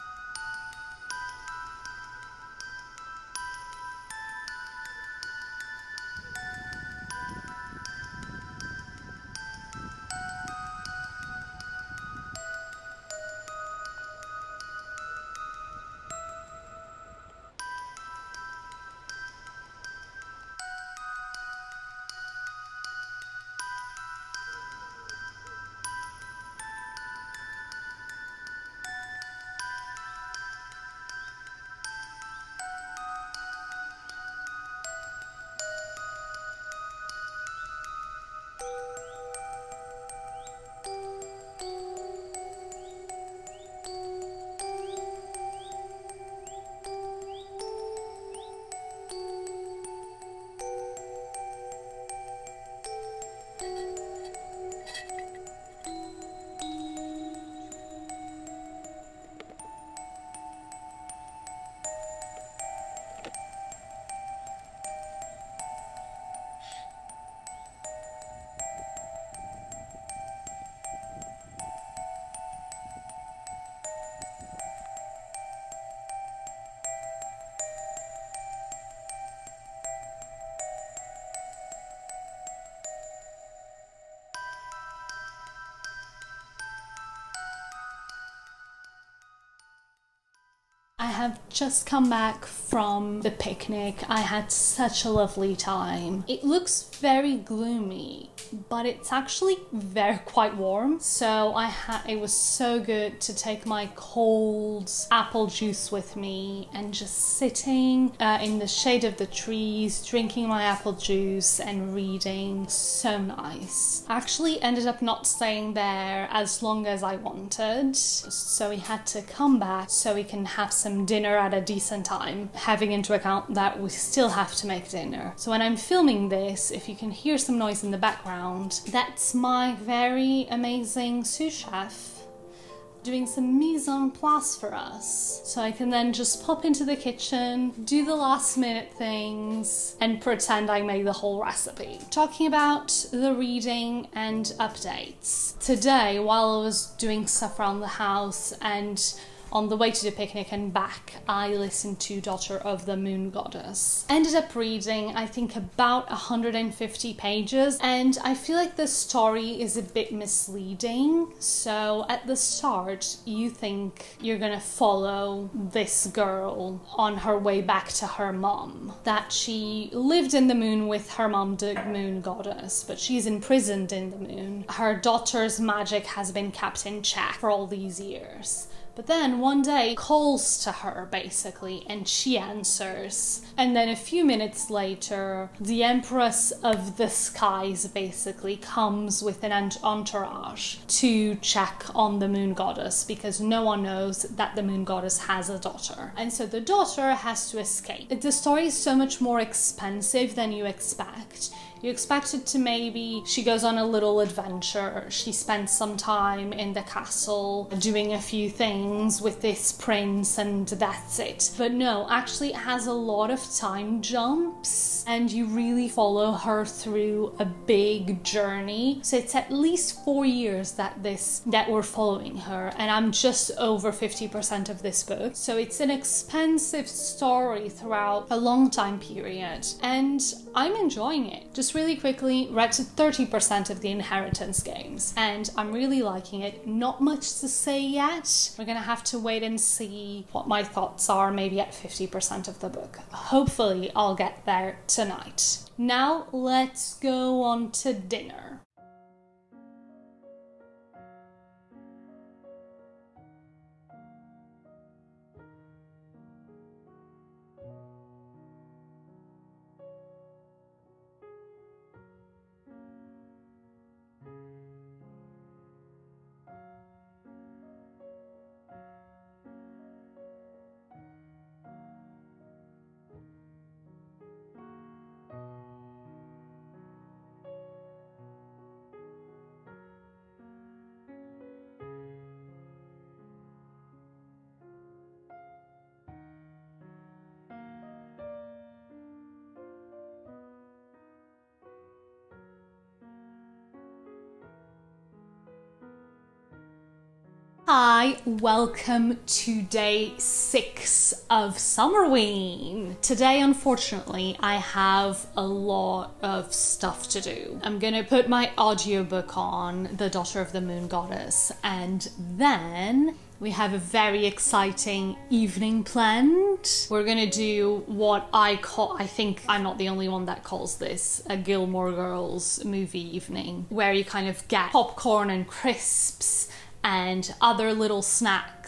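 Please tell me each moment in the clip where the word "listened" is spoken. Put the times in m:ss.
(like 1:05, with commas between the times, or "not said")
2:31.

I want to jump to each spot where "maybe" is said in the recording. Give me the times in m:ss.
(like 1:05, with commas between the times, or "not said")
3:22, 4:01.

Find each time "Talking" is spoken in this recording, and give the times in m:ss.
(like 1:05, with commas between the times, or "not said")
2:22.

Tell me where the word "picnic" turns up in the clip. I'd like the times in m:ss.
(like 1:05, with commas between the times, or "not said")
1:33, 2:30.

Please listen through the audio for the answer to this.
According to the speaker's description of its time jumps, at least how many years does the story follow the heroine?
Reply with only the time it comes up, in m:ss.
3:40.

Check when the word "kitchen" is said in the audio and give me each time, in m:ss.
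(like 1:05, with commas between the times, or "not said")
2:16.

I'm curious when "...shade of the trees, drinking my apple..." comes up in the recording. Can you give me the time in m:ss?
1:48.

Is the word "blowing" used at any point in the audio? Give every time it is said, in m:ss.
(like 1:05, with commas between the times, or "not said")
not said.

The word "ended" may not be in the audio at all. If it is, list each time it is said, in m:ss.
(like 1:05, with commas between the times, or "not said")
1:54, 2:34.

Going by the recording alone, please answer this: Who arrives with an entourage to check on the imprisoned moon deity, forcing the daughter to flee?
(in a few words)
the Empress of the Skies.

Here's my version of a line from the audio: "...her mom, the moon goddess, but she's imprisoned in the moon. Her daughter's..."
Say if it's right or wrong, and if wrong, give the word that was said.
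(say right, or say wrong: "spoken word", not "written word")
right.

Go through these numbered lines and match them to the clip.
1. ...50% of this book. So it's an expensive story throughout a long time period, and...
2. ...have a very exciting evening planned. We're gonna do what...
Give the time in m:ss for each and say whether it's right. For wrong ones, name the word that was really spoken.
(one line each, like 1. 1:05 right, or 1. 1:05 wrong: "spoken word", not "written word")
1. 3:43 right
2. 5:13 right.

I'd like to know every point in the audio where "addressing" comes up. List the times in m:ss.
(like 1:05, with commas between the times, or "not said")
not said.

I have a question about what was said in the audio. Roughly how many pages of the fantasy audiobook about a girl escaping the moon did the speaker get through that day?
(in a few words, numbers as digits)
150.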